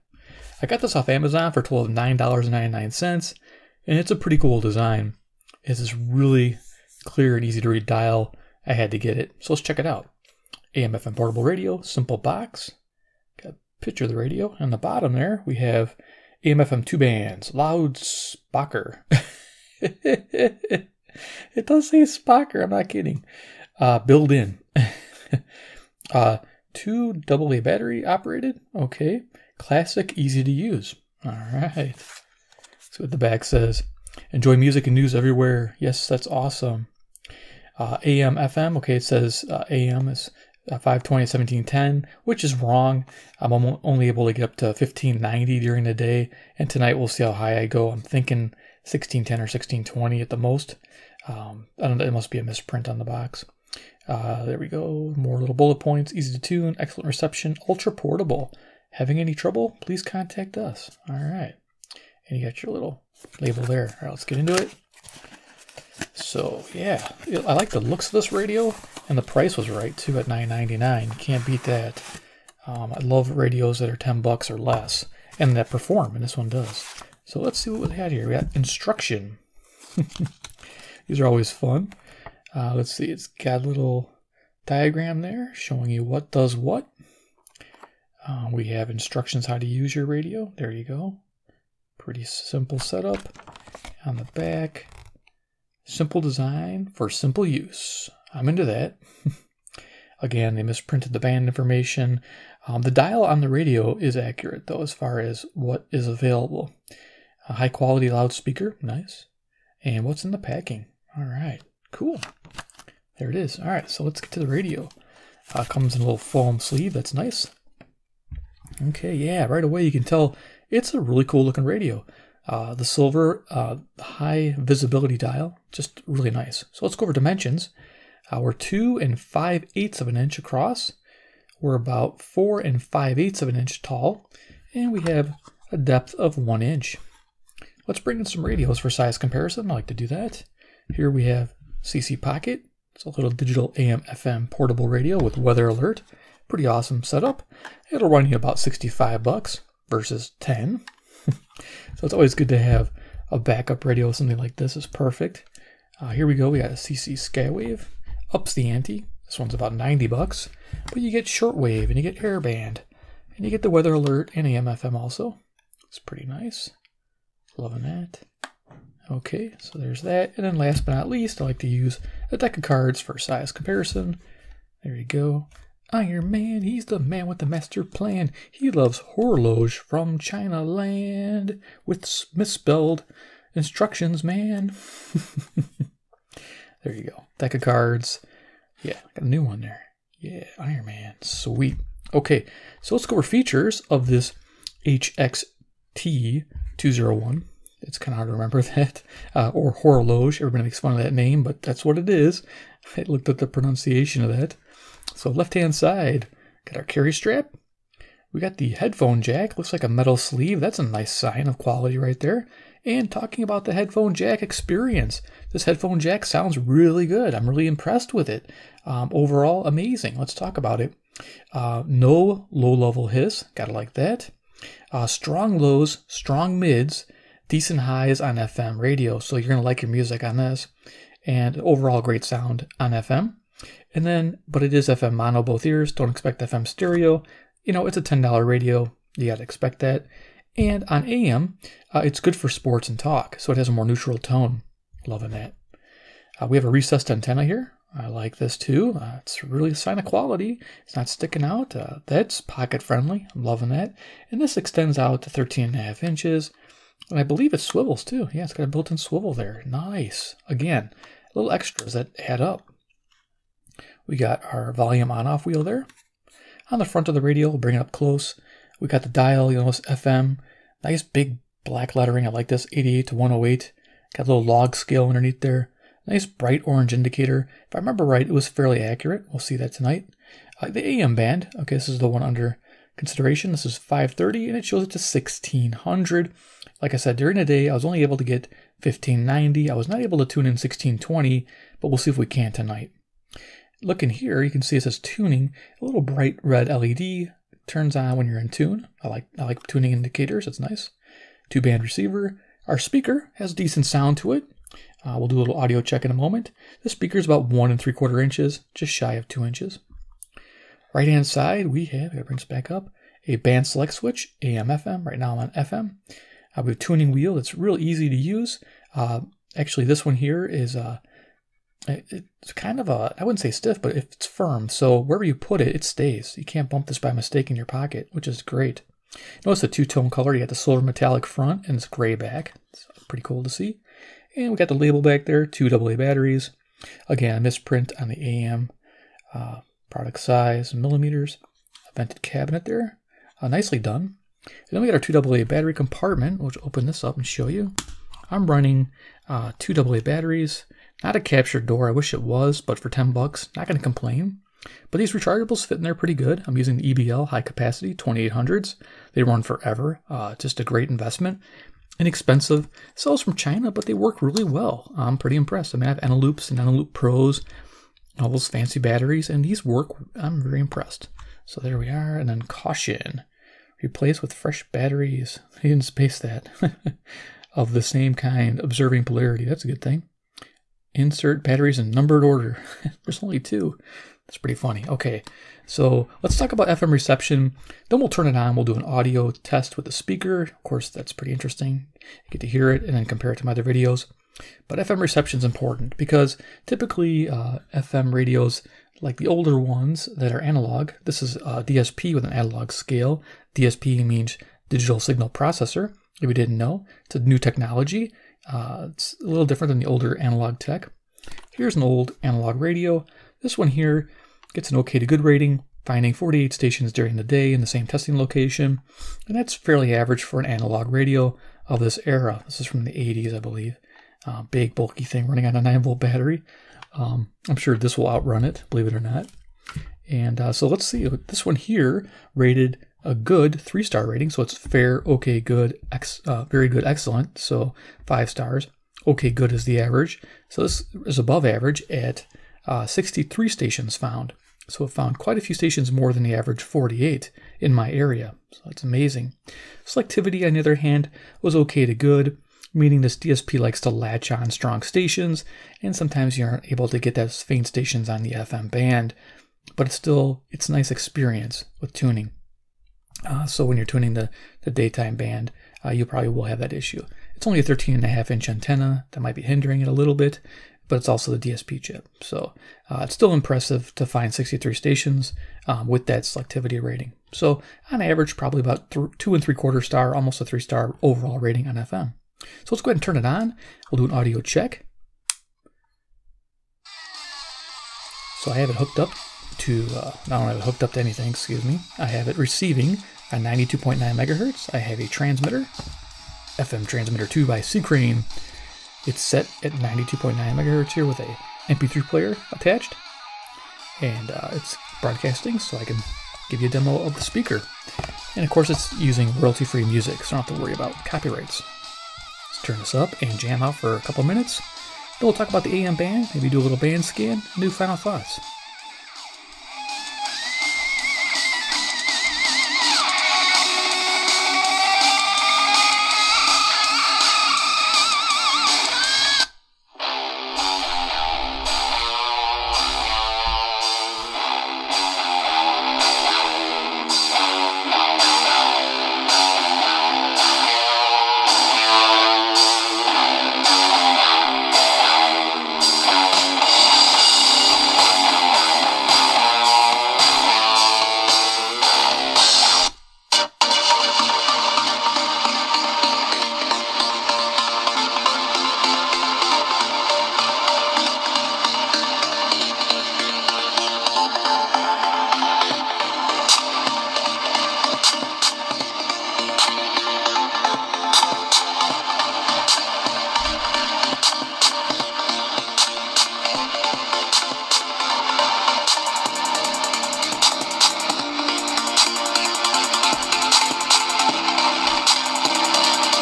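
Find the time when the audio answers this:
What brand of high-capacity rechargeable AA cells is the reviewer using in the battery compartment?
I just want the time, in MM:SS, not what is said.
05:56.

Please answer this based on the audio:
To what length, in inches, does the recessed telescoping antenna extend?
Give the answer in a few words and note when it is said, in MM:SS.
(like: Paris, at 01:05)
13.5 inches, at 04:15.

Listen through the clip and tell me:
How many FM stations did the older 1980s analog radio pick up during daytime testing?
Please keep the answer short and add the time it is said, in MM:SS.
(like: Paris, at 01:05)
48, at 06:56.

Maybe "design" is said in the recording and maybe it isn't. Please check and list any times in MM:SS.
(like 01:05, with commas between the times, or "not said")
00:04, 01:36.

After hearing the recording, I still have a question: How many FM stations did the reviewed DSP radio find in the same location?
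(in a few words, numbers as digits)
63.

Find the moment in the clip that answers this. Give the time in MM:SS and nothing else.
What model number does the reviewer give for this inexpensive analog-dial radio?
03:14.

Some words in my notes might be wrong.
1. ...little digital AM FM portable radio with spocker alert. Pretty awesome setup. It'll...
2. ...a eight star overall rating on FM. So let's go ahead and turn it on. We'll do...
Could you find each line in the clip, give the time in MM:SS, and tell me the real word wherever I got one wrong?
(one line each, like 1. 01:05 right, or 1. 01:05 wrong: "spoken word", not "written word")
1. 02:23 wrong: "weather", not "spocker"
2. 08:00 wrong: "three", not "eight".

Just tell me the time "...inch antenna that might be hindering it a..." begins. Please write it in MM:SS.
07:48.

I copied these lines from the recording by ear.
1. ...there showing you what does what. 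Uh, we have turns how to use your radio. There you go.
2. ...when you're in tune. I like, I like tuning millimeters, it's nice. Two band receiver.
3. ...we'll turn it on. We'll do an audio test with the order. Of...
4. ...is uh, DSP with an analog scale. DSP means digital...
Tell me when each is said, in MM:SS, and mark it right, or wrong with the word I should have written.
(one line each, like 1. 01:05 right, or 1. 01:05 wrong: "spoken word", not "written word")
1. 01:25 wrong: "instructions", not "turns"
2. 04:58 wrong: "indicators", not "millimeters"
3. 06:27 wrong: "speaker", not "order"
4. 06:41 right.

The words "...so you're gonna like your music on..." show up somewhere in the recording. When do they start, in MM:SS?
03:49.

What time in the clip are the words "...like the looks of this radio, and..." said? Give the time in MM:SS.
01:07.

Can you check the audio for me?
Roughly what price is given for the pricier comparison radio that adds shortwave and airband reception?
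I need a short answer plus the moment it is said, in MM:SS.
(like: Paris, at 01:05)
$90, at 02:39.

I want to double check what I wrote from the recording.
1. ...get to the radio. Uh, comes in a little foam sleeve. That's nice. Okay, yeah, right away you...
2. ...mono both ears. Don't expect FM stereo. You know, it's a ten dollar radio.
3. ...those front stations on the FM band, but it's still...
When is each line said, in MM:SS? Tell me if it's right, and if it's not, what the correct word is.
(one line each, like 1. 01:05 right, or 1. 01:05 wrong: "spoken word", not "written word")
1. 01:54 right
2. 03:55 right
3. 07:37 wrong: "faint", not "front".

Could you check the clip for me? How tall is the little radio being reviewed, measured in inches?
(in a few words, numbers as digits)
4 and 5/8 inches.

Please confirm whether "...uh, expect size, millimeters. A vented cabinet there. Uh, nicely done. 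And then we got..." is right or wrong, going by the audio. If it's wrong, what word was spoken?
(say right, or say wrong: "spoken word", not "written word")
wrong: "product", not "expect".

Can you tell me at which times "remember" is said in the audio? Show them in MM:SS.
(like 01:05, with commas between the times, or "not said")
03:18, 04:37.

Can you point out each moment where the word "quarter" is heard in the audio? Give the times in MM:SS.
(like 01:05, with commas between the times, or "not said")
05:07, 07:59.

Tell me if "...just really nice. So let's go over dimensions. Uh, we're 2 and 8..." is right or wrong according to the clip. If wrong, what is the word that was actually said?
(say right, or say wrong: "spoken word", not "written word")
wrong: "5", not "8".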